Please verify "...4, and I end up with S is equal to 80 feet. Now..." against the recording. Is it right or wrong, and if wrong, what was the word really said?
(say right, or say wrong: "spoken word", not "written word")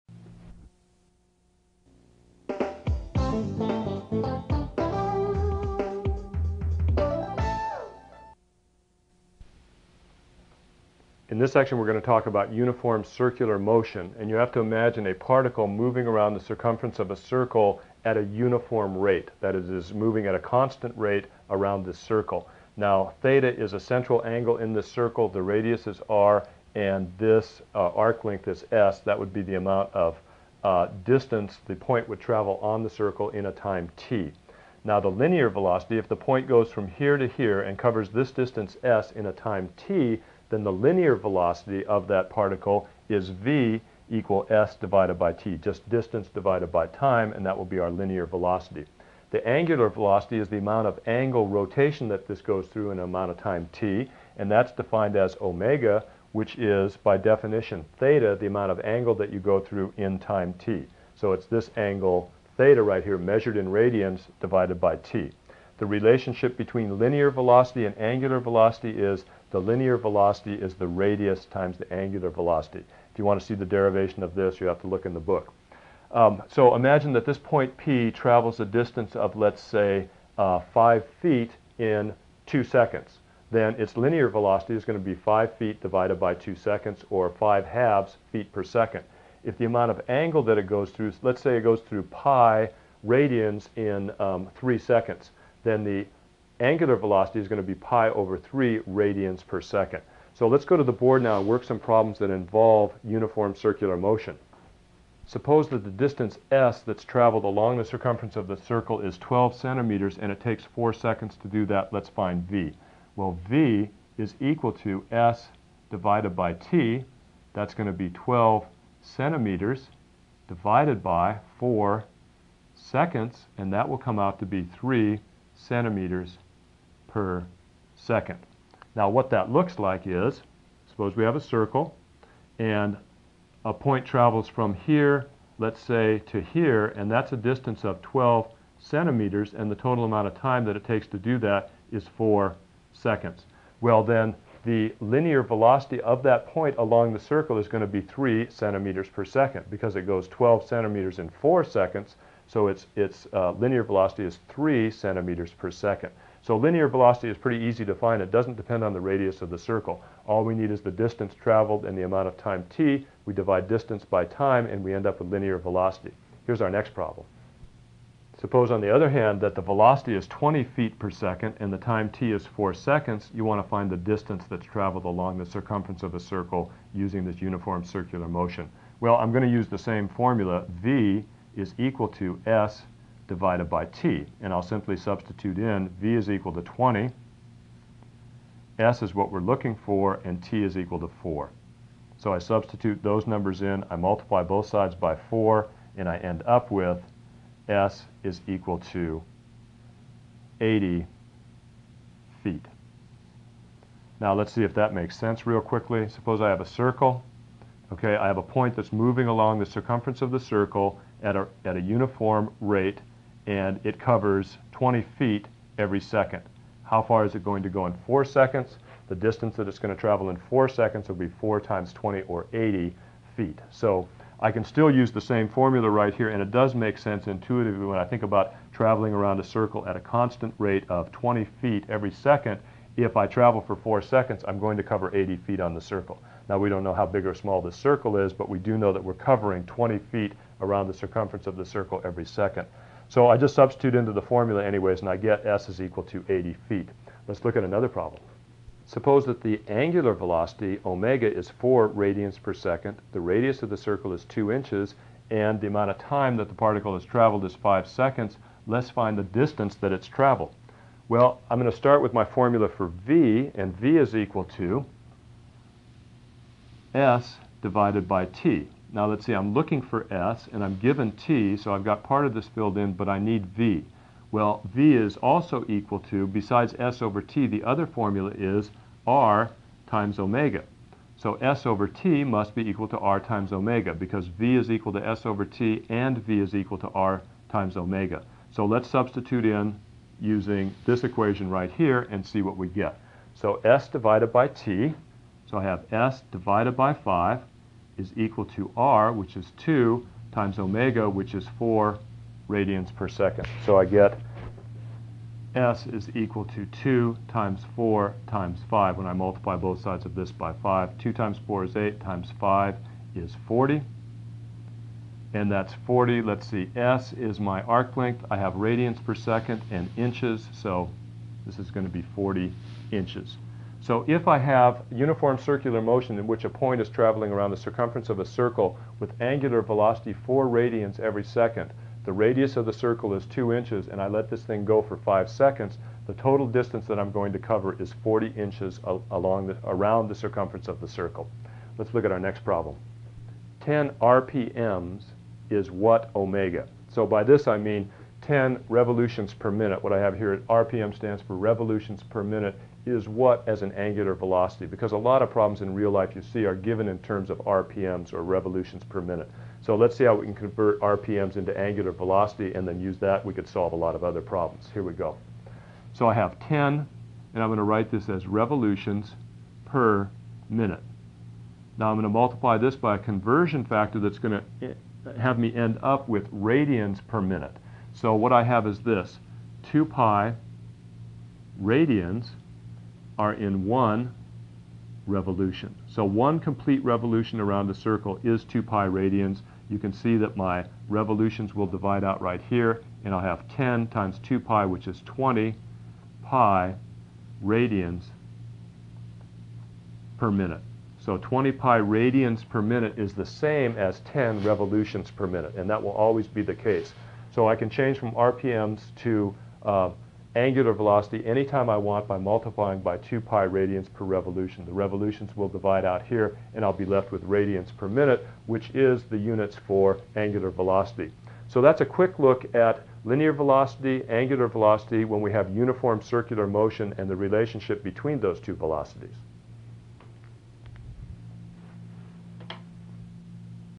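right.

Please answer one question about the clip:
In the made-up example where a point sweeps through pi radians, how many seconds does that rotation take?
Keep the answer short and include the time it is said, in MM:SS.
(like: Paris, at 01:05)
3 seconds, at 01:34.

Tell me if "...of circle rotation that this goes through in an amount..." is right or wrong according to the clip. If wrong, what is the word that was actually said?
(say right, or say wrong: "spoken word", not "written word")
wrong: "angle", not "circle".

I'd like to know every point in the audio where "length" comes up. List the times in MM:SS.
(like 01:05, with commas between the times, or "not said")
00:28, 05:17.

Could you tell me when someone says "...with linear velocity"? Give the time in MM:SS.
02:45.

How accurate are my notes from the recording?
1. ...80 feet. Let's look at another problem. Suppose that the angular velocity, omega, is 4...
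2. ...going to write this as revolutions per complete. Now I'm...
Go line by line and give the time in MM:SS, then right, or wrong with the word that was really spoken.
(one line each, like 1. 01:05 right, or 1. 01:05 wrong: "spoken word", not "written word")
1. 04:06 right
2. 06:07 wrong: "minute", not "complete".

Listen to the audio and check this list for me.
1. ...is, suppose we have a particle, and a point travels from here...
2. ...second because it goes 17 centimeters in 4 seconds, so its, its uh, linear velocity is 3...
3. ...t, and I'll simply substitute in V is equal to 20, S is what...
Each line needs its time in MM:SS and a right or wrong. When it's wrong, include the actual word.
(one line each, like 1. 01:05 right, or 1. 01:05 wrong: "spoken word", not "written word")
1. 02:10 wrong: "circle", not "particle"
2. 02:29 wrong: "12", not "17"
3. 03:03 right.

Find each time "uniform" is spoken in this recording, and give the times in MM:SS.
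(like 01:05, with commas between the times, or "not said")
00:12, 00:18, 01:43, 02:57, 03:31, 05:24, 07:05.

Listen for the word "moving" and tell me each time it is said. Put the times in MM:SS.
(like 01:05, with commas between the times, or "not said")
00:15, 00:19, 03:28.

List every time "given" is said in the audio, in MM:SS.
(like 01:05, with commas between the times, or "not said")
04:30, 05:56.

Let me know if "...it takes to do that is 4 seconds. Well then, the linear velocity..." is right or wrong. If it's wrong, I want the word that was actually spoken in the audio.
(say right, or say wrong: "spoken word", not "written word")
right.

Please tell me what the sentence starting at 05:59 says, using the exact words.
So let's see how we can convert RPMs into angular velocity and then use that.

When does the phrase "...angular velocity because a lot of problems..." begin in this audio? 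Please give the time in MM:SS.
05:53.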